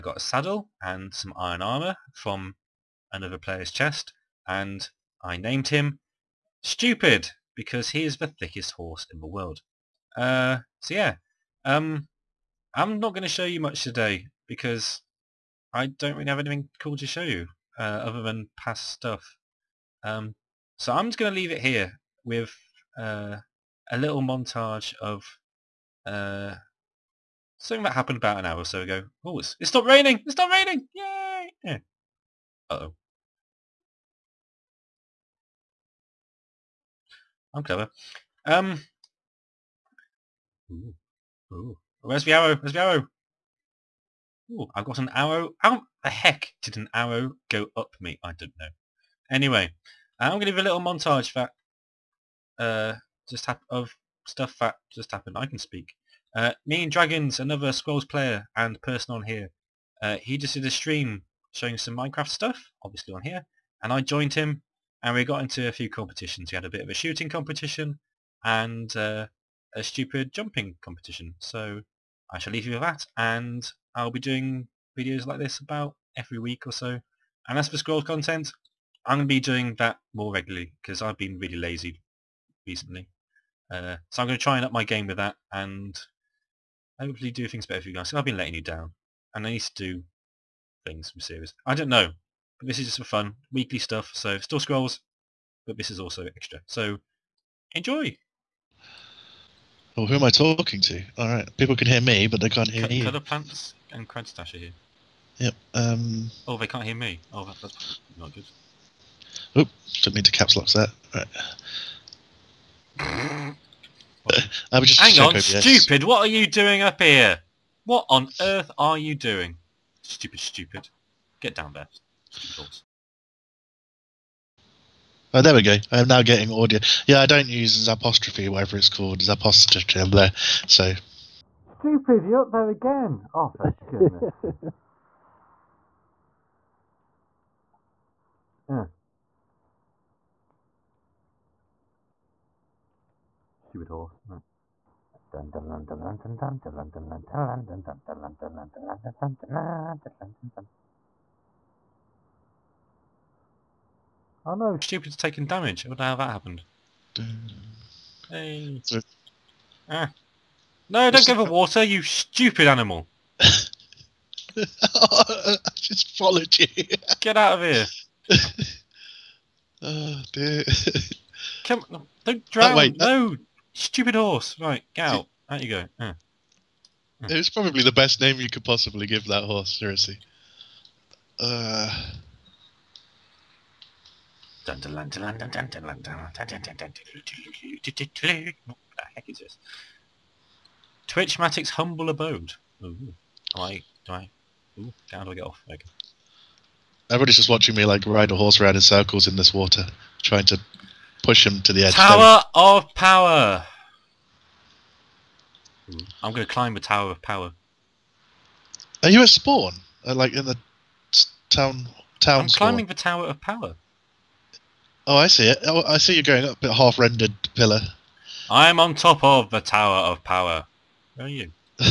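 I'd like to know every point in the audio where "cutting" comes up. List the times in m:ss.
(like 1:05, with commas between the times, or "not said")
not said.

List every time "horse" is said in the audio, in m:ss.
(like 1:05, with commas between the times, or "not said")
0:08, 2:23, 2:54, 2:59, 3:18.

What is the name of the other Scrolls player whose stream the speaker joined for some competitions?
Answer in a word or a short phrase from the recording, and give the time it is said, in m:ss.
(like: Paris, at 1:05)
Dragons, at 0:56.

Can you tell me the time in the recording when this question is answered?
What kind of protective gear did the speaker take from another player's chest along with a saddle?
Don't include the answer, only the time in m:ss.
0:01.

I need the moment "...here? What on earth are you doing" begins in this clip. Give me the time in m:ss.
1:57.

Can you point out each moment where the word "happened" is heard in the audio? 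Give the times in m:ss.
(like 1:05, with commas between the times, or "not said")
0:27, 0:55, 2:36.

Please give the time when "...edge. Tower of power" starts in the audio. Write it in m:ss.
3:21.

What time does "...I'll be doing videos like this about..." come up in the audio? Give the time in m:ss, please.
1:13.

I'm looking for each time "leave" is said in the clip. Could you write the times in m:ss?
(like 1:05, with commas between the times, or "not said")
0:21, 1:12.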